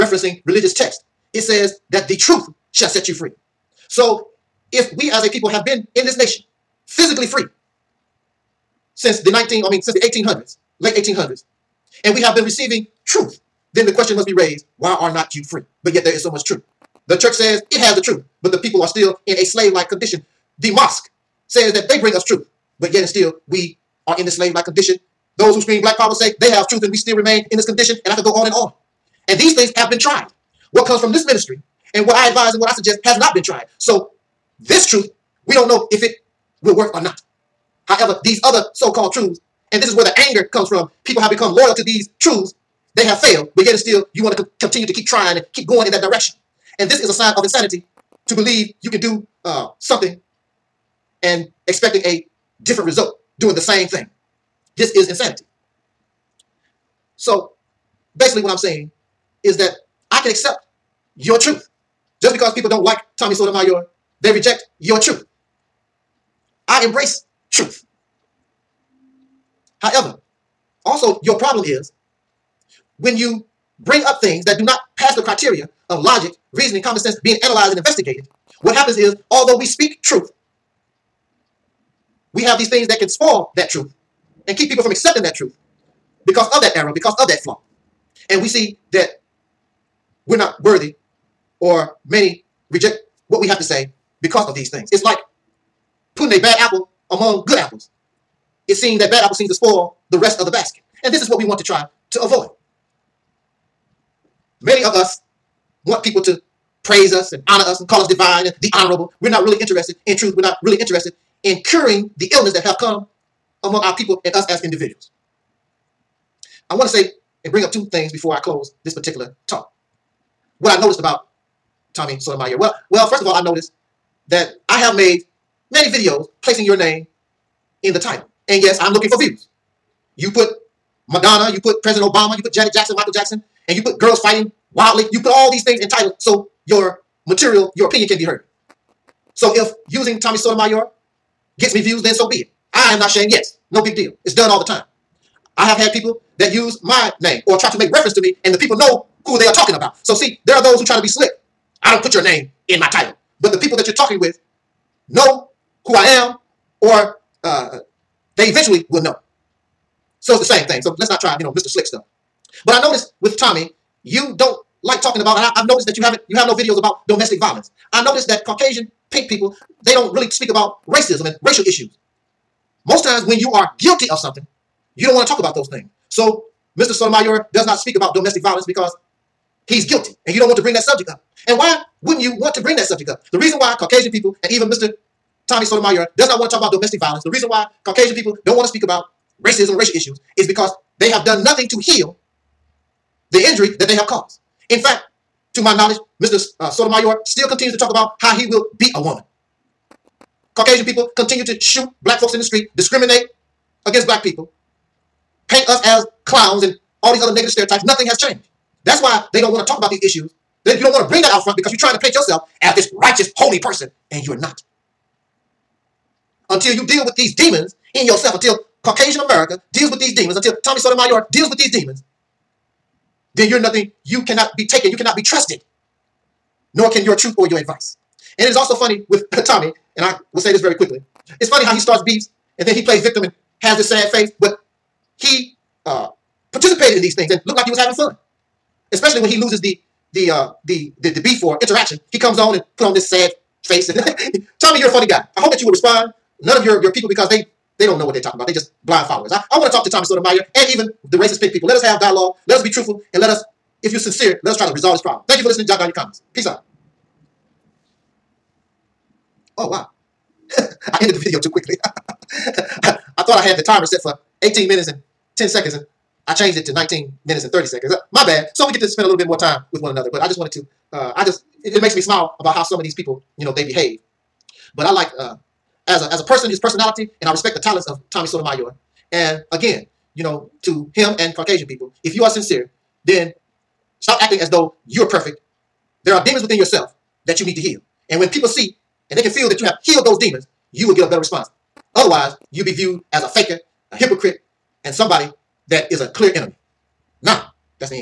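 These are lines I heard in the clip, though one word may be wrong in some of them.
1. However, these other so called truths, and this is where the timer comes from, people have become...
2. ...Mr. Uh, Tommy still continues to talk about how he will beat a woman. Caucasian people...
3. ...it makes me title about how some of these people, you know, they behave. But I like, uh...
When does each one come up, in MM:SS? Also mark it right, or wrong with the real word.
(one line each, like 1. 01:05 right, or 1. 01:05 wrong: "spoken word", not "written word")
1. 00:37 wrong: "anger", not "timer"
2. 03:16 wrong: "Sotomayor", not "Tommy"
3. 04:31 wrong: "smile", not "title".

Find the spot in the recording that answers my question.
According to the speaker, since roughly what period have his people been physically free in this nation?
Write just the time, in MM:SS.
00:10.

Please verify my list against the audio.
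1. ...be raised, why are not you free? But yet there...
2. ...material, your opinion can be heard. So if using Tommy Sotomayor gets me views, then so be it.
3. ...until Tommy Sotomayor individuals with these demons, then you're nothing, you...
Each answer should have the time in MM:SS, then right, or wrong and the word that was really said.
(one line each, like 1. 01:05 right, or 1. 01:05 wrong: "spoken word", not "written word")
1. 00:14 right
2. 02:17 right
3. 03:40 wrong: "deals", not "individuals".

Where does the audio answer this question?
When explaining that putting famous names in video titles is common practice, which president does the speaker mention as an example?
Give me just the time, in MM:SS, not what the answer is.
02:11.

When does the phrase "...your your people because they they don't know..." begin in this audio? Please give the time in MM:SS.
04:06.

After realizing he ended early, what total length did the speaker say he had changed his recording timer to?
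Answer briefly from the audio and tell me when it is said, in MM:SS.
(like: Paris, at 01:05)
19 minutes and 30 seconds, at 04:26.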